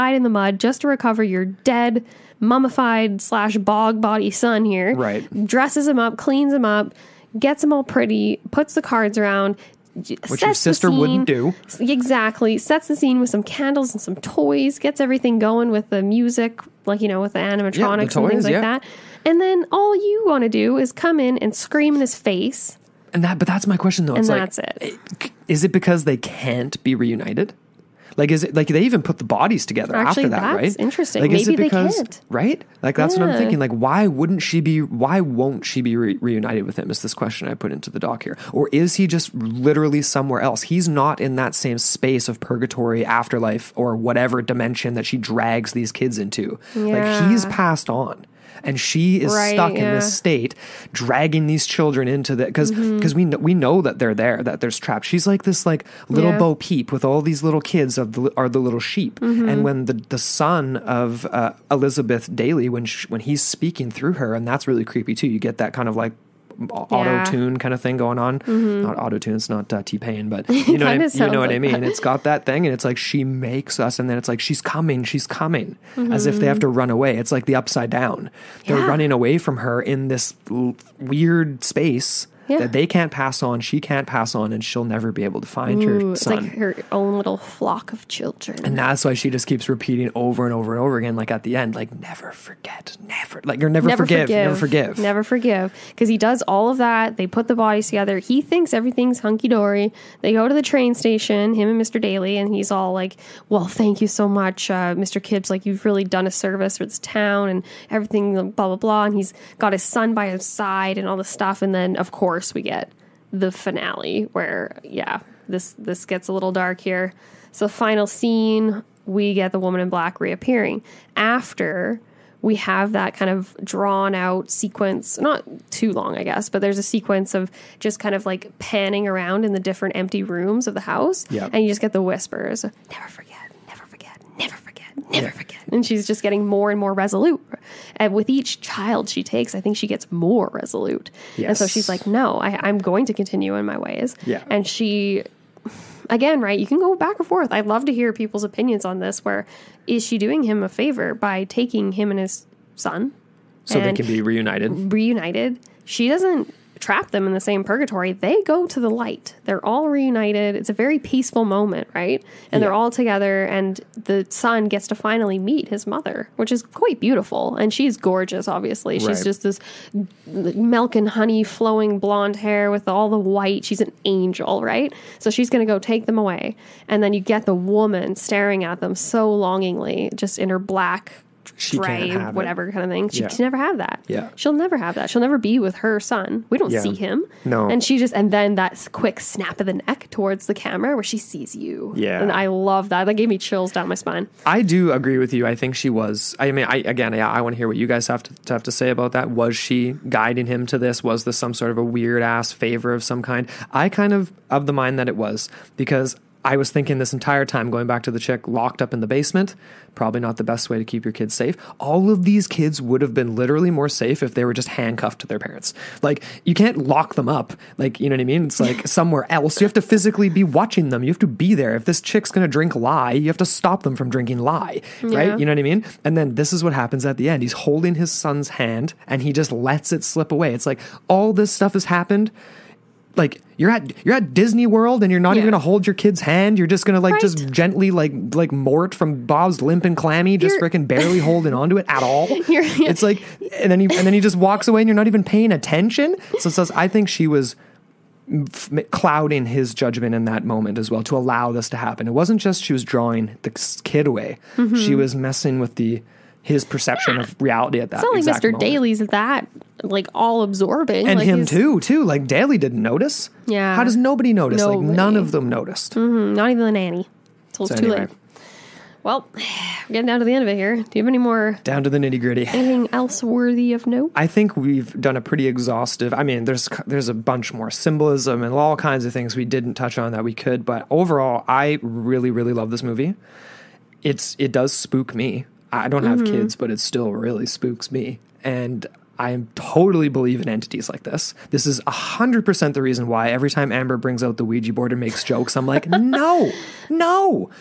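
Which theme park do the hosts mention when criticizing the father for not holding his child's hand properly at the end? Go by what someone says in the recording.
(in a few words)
Disney World.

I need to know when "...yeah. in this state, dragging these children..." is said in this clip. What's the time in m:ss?
0:49.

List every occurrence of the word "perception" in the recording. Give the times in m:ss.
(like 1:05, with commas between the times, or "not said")
4:16.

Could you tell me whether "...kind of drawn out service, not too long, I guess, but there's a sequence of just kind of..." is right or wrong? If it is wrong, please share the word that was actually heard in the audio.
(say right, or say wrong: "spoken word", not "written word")
wrong: "sequence", not "service".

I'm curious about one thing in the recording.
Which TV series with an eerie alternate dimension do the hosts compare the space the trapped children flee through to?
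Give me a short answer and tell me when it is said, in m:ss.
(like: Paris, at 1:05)
The upside down, at 1:17.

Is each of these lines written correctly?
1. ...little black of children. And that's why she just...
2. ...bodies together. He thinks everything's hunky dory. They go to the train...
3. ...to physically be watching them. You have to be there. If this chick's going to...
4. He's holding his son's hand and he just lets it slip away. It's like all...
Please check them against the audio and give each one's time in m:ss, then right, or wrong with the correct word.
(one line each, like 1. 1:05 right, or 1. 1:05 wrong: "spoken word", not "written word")
1. 1:27 wrong: "flock", not "black"
2. 1:37 right
3. 3:39 right
4. 3:47 right.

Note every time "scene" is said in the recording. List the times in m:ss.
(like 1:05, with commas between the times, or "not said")
0:12, 1:58.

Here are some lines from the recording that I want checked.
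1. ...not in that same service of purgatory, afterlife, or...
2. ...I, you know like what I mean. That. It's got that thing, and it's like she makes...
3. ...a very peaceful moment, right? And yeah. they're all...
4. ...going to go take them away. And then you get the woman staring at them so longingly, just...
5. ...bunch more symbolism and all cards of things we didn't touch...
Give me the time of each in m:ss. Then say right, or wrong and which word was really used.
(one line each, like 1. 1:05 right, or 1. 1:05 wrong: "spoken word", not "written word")
1. 0:40 wrong: "space", not "service"
2. 1:10 right
3. 2:40 right
4. 2:55 right
5. 4:37 wrong: "kinds", not "cards".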